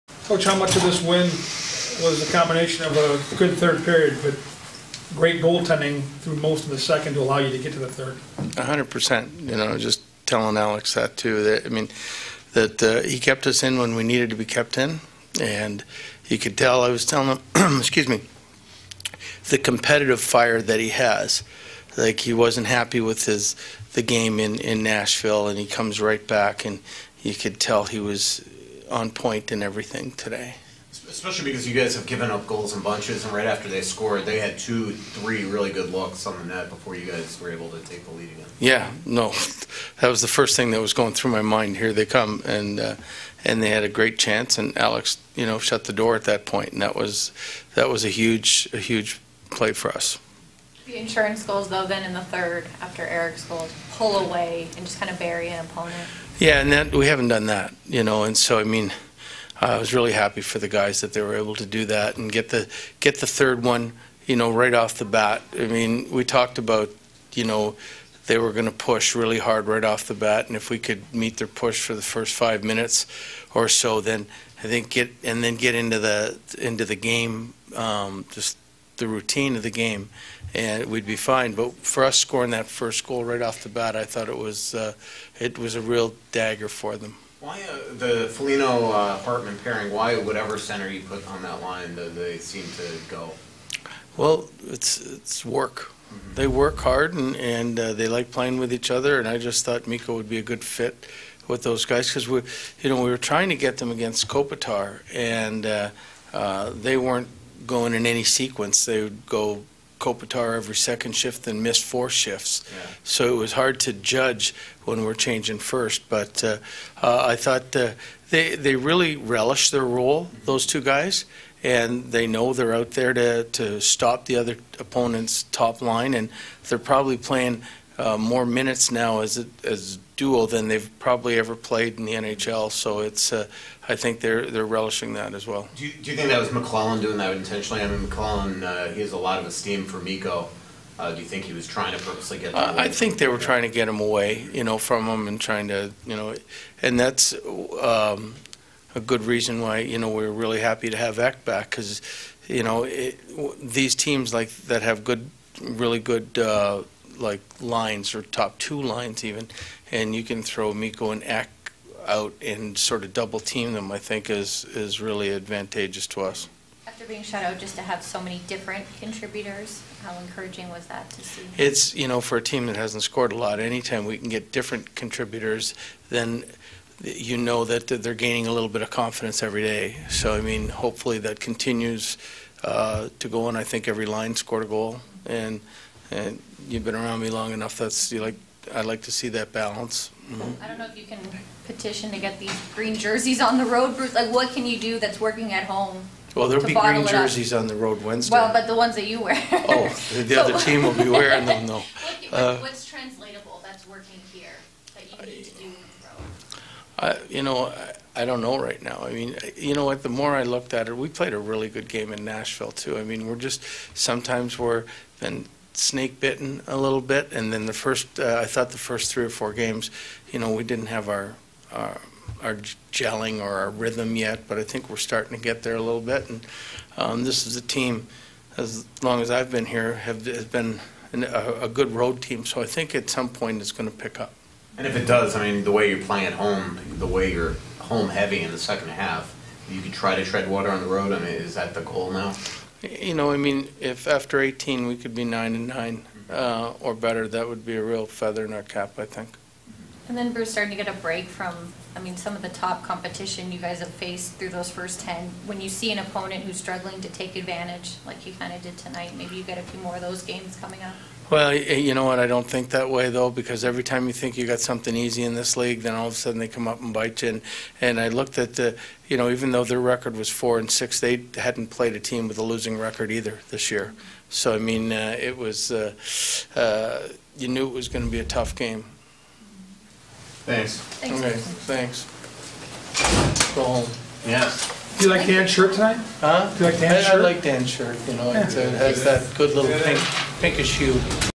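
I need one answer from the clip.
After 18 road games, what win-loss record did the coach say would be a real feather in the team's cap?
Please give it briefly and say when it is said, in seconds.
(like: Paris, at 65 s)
9 and 9, at 245 s.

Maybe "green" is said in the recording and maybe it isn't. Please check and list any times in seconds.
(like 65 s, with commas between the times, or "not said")
192 s, 196 s.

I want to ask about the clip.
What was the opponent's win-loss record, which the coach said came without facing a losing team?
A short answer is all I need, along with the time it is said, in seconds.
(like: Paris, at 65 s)
4 and 6, at 270 s.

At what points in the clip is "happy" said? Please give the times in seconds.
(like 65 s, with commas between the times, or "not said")
22 s, 60 s, 150 s.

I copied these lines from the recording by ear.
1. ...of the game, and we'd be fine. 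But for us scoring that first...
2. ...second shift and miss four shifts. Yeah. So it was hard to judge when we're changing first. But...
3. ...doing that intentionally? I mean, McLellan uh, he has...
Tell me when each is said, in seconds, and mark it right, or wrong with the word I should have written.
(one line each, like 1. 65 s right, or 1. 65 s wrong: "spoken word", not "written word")
1. 79 s right
2. 110 s right
3. 137 s right.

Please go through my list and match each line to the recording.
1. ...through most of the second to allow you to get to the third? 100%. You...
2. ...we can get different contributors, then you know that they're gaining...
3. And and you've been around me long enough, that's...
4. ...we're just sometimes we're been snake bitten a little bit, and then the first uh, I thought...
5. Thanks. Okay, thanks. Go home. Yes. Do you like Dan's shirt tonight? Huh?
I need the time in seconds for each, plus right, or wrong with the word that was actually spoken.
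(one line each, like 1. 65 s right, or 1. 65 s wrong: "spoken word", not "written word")
1. 6 s right
2. 174 s right
3. 185 s right
4. 213 s right
5. 280 s right.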